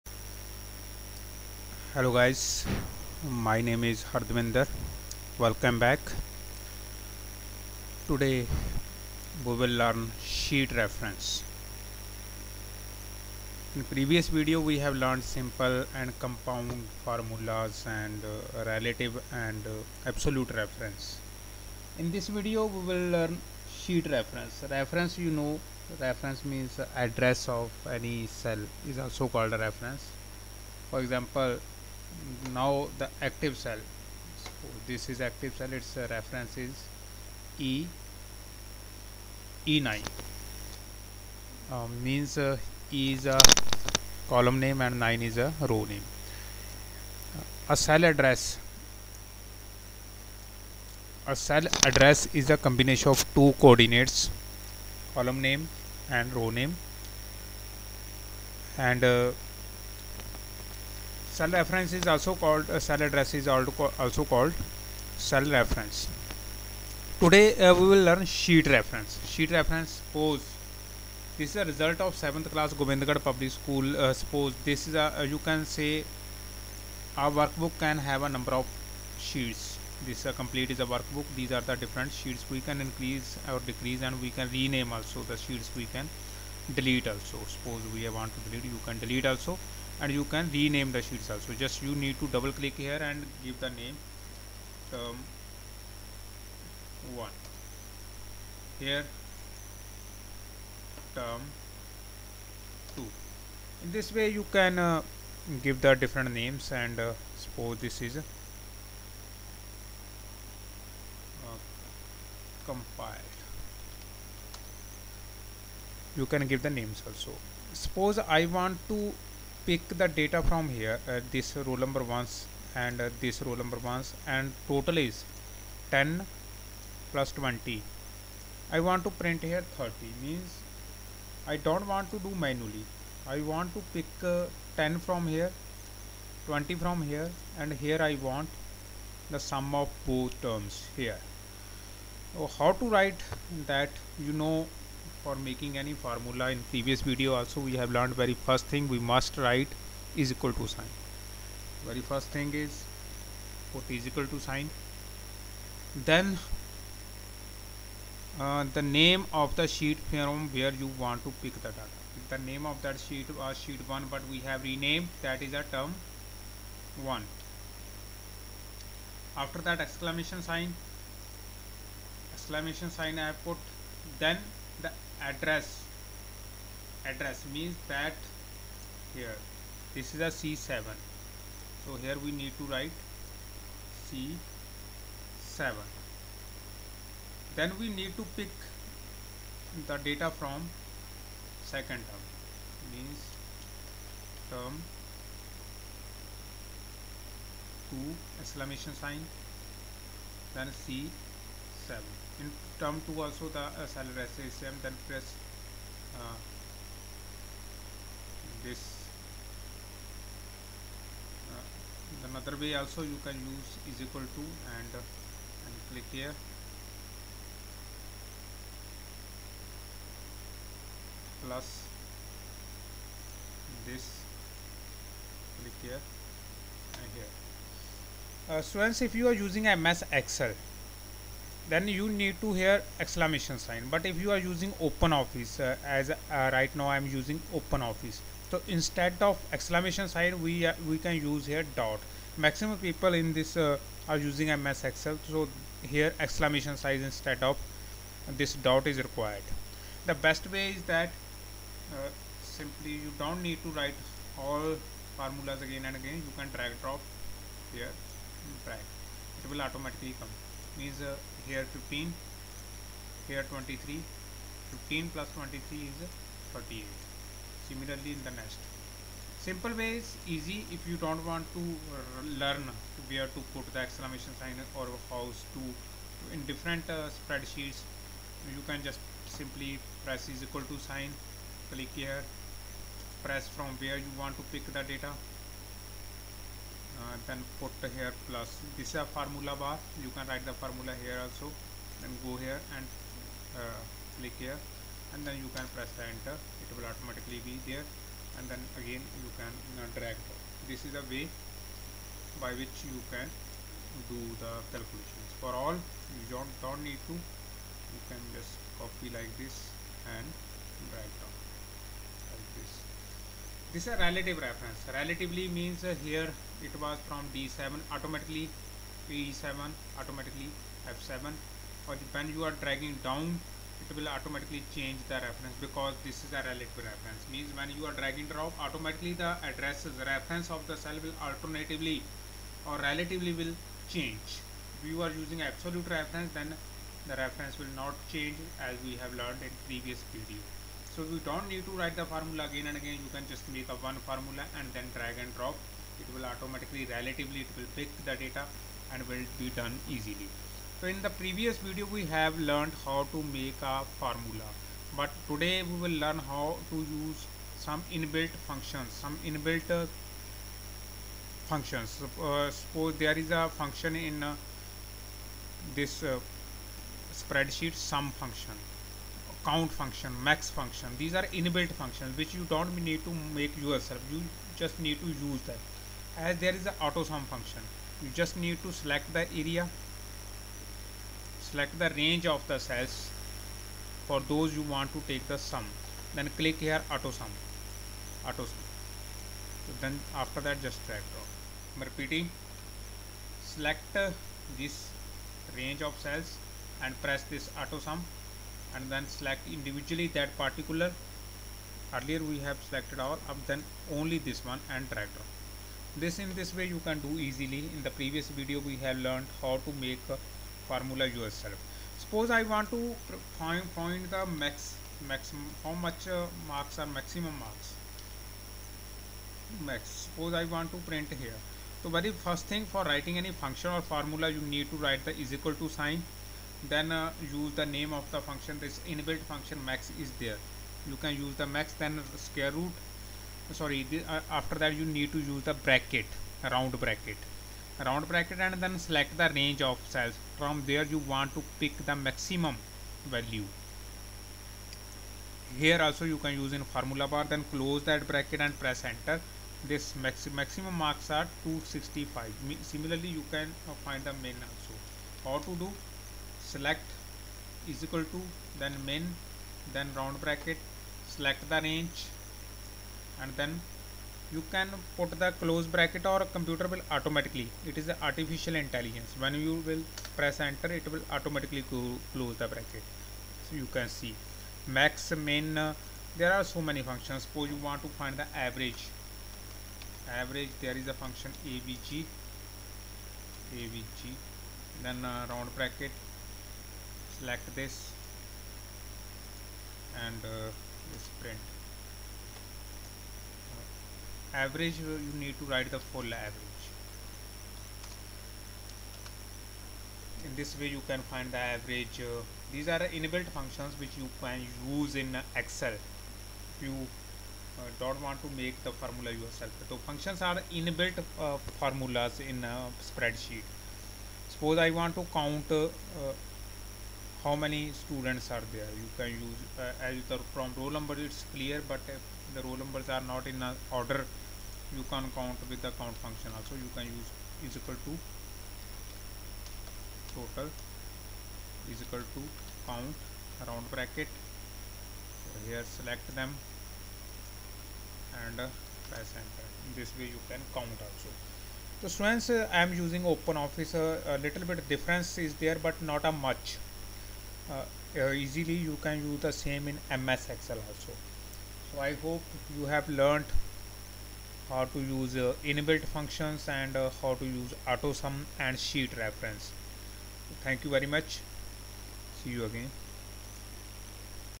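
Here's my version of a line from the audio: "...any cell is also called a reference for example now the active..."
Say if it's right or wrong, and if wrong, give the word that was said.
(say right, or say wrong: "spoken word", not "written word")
right.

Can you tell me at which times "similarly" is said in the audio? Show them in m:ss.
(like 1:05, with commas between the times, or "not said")
4:27, 7:32.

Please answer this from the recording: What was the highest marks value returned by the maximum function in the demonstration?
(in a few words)
265.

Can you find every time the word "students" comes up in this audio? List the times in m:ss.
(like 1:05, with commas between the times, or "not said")
3:48, 8:37, 9:01.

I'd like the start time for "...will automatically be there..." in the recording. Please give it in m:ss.
4:56.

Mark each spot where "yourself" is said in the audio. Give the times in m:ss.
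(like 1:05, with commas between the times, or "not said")
6:13, 6:51, 8:29.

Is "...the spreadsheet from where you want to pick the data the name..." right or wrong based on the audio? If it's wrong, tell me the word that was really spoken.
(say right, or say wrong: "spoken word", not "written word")
wrong: "sheet", not "spreadsheet".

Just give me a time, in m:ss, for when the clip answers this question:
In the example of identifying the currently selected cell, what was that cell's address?
0:39.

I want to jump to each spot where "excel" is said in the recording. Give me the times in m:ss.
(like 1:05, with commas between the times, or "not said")
3:50, 4:04, 8:25, 9:10.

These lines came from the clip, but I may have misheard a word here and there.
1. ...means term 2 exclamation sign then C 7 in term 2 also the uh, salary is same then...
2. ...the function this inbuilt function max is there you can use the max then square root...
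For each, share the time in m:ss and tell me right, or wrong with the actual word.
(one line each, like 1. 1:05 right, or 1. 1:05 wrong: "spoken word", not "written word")
1. 3:12 right
2. 7:08 right.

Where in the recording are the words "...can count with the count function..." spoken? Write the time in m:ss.
8:44.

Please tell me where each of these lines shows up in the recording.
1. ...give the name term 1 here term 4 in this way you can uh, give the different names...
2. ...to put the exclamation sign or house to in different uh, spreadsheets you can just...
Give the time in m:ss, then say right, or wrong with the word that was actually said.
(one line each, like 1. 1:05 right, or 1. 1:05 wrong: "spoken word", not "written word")
1. 1:33 wrong: "2", not "4"
2. 4:33 right.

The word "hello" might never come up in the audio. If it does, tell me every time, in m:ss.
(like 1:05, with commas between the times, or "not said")
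0:01.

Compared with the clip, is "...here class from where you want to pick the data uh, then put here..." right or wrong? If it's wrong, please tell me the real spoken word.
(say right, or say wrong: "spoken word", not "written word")
wrong: "press", not "class".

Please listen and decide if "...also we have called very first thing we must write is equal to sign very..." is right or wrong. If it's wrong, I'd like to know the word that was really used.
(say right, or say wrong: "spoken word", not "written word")
wrong: "learned", not "called".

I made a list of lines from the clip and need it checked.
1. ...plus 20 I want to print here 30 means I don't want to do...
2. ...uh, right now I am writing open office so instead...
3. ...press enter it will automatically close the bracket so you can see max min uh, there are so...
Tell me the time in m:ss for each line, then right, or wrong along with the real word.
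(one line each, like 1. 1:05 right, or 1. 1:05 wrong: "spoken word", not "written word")
1. 2:07 right
2. 3:56 wrong: "using", not "writing"
3. 7:50 right.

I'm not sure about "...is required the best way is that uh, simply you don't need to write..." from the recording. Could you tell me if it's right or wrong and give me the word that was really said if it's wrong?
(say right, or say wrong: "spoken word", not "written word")
right.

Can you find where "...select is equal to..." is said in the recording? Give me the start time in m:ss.
7:36.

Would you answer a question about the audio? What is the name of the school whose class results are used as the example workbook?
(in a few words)
Govindgarh public school.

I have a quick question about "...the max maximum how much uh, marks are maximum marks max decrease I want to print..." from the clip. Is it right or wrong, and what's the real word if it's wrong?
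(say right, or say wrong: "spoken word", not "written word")
wrong: "suppose", not "decrease".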